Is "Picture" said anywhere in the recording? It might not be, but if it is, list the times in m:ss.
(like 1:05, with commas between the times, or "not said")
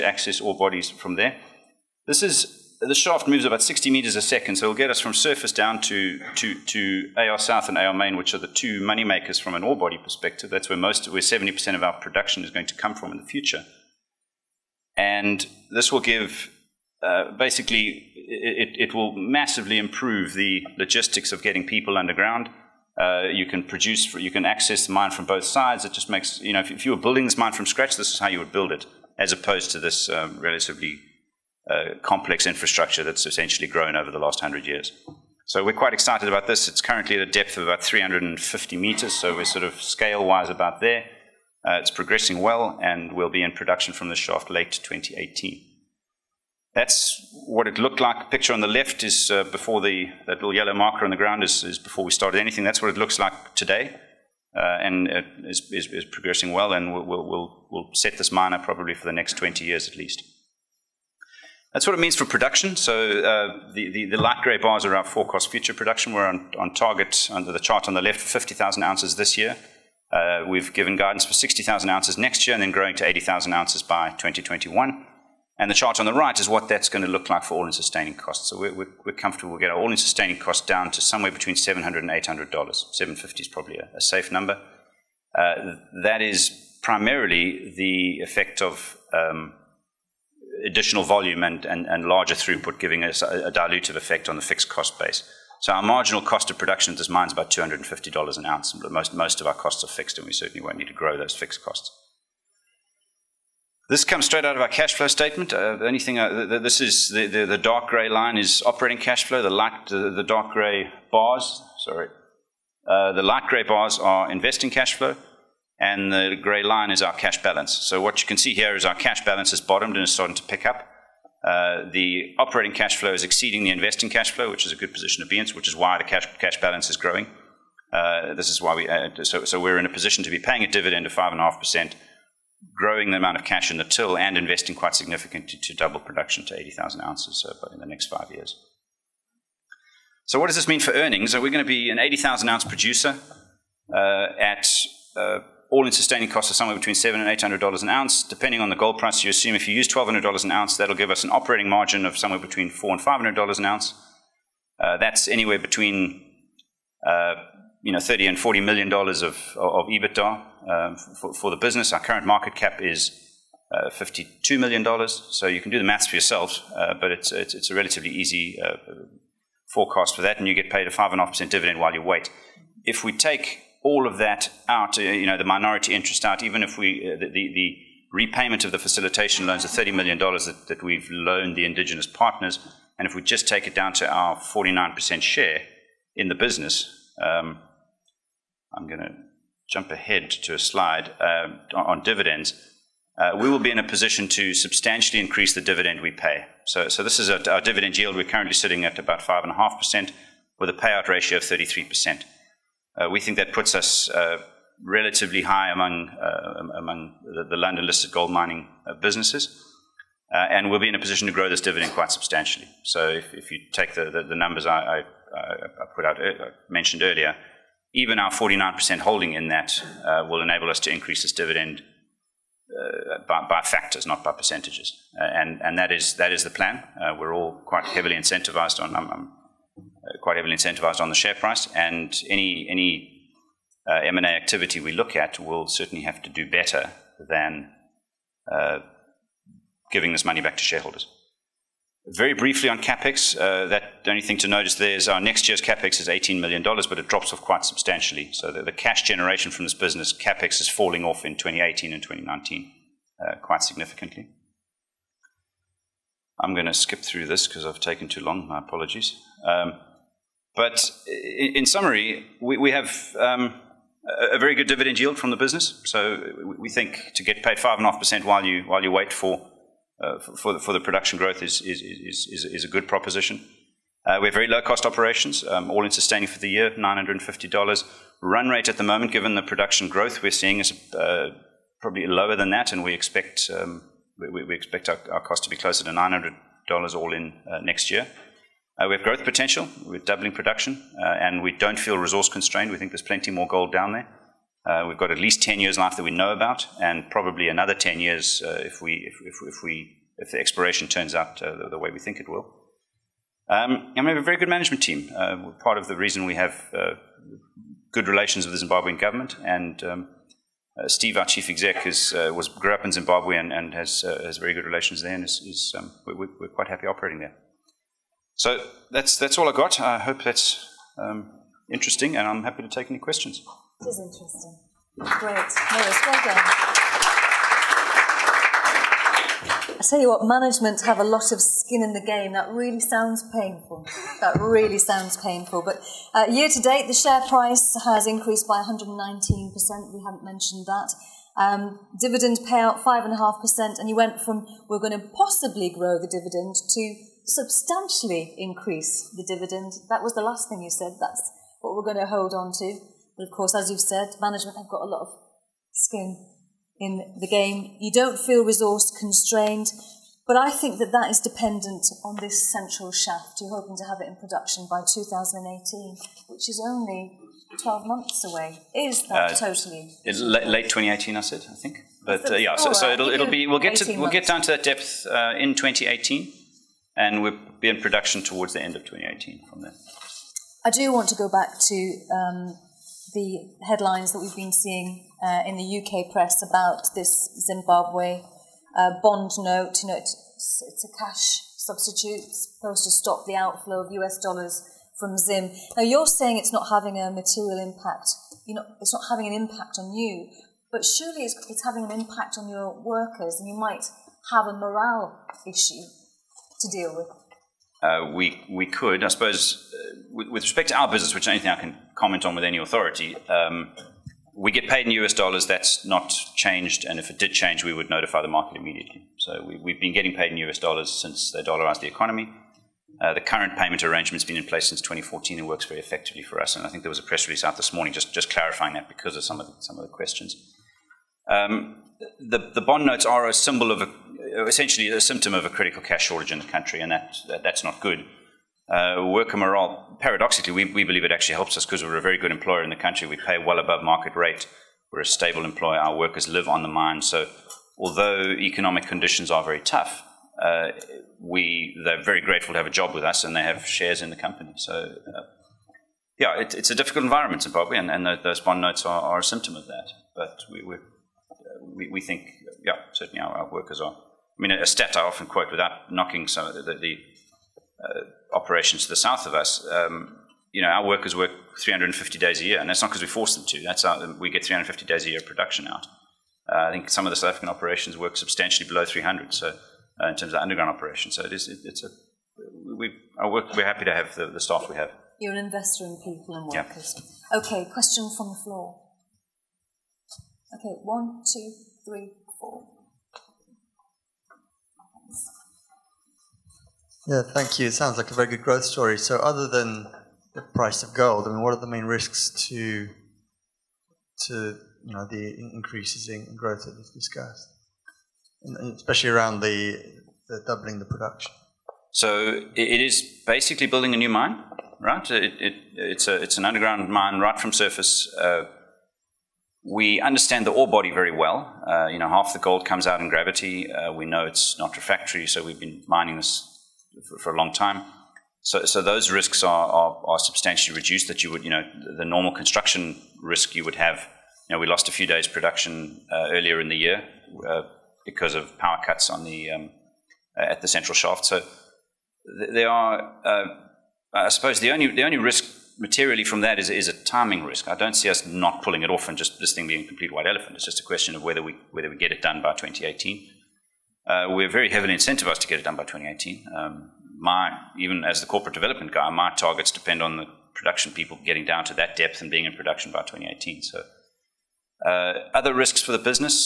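0:48.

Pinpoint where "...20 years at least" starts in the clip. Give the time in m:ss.
0:59.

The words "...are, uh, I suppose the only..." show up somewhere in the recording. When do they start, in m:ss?
9:02.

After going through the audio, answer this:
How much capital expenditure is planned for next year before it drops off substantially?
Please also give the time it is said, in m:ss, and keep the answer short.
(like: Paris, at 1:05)
$18 million, at 4:06.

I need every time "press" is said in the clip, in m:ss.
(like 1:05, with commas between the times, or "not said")
6:26, 7:07.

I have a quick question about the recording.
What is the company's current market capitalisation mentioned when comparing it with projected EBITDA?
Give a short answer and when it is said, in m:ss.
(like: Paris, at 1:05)
52 million dollars, at 2:43.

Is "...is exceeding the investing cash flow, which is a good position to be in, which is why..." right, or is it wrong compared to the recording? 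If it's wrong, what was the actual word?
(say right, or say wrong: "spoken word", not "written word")
right.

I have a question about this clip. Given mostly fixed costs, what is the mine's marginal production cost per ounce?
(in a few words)
$250 an ounce.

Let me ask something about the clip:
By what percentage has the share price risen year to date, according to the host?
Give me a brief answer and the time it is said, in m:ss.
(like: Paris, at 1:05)
119%, at 5:38.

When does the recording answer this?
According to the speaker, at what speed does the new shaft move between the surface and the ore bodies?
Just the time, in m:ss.
0:03.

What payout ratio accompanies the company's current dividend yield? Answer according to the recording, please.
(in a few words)
33%.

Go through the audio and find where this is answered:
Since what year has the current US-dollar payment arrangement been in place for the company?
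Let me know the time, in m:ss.
7:04.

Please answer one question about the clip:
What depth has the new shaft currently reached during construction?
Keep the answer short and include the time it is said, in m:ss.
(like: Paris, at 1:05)
350 meters, at 0:37.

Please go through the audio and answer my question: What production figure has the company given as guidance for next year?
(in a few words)
60,000 ounces.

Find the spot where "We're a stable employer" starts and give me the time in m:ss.
7:24.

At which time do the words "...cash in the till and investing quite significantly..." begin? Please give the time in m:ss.
2:13.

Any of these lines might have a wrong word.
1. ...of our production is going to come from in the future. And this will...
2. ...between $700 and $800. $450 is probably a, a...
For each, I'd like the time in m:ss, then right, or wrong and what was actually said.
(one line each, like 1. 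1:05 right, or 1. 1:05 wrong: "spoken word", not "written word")
1. 0:11 right
2. 1:21 wrong: "750", not "450".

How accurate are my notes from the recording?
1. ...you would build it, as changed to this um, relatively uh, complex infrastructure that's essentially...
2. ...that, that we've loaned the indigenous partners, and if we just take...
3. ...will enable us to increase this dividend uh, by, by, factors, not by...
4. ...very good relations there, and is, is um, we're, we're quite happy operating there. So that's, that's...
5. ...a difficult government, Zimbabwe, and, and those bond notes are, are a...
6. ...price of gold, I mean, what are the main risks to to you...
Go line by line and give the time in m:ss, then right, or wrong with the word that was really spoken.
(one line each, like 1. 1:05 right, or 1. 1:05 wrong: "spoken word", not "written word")
1. 0:28 wrong: "opposed", not "changed"
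2. 3:00 right
3. 3:40 right
4. 5:14 right
5. 7:36 wrong: "environment", not "government"
6. 8:20 right.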